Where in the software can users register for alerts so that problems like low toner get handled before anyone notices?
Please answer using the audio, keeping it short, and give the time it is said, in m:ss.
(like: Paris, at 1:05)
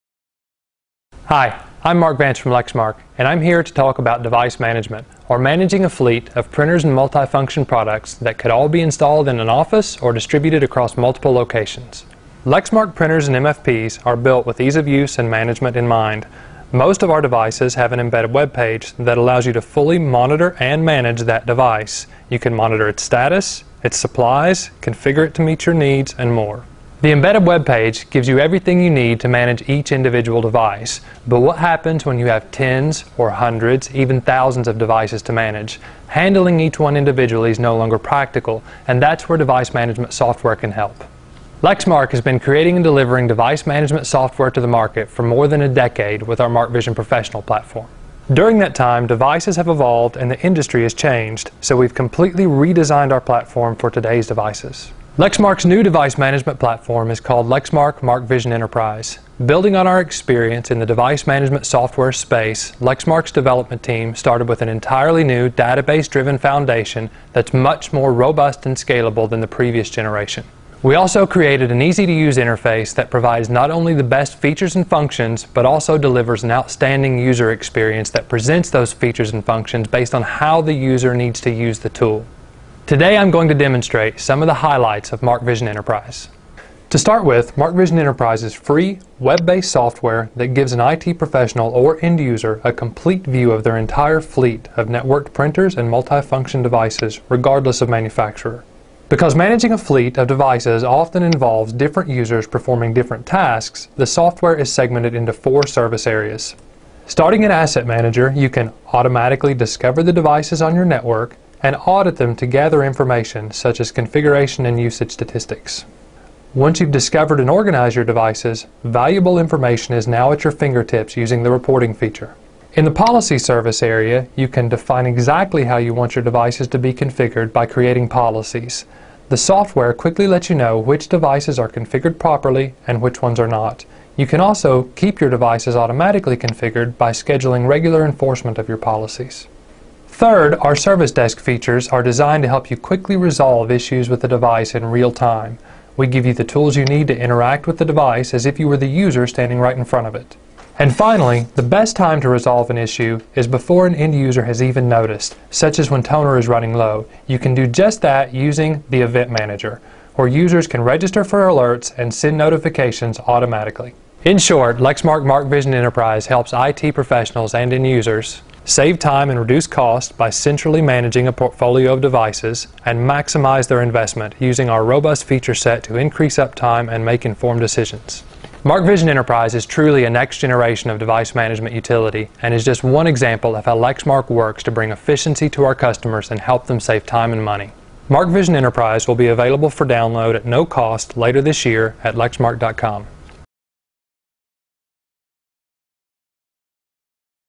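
Event Manager, at 2:39.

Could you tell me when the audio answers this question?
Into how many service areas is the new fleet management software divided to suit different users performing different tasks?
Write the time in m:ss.
1:45.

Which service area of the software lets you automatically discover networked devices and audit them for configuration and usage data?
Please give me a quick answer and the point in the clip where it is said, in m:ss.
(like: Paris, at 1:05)
Asset Manager, at 1:47.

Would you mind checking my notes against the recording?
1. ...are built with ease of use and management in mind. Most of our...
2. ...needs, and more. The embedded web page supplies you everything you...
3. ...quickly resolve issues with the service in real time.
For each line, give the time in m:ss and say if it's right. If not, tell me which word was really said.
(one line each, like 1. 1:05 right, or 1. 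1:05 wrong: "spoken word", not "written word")
1. 0:14 right
2. 0:25 wrong: "gives", not "supplies"
3. 2:22 wrong: "device", not "service".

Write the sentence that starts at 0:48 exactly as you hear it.
During that time, devices have evolved and the industry has changed, so we've completely redesigned our platform for today's devices.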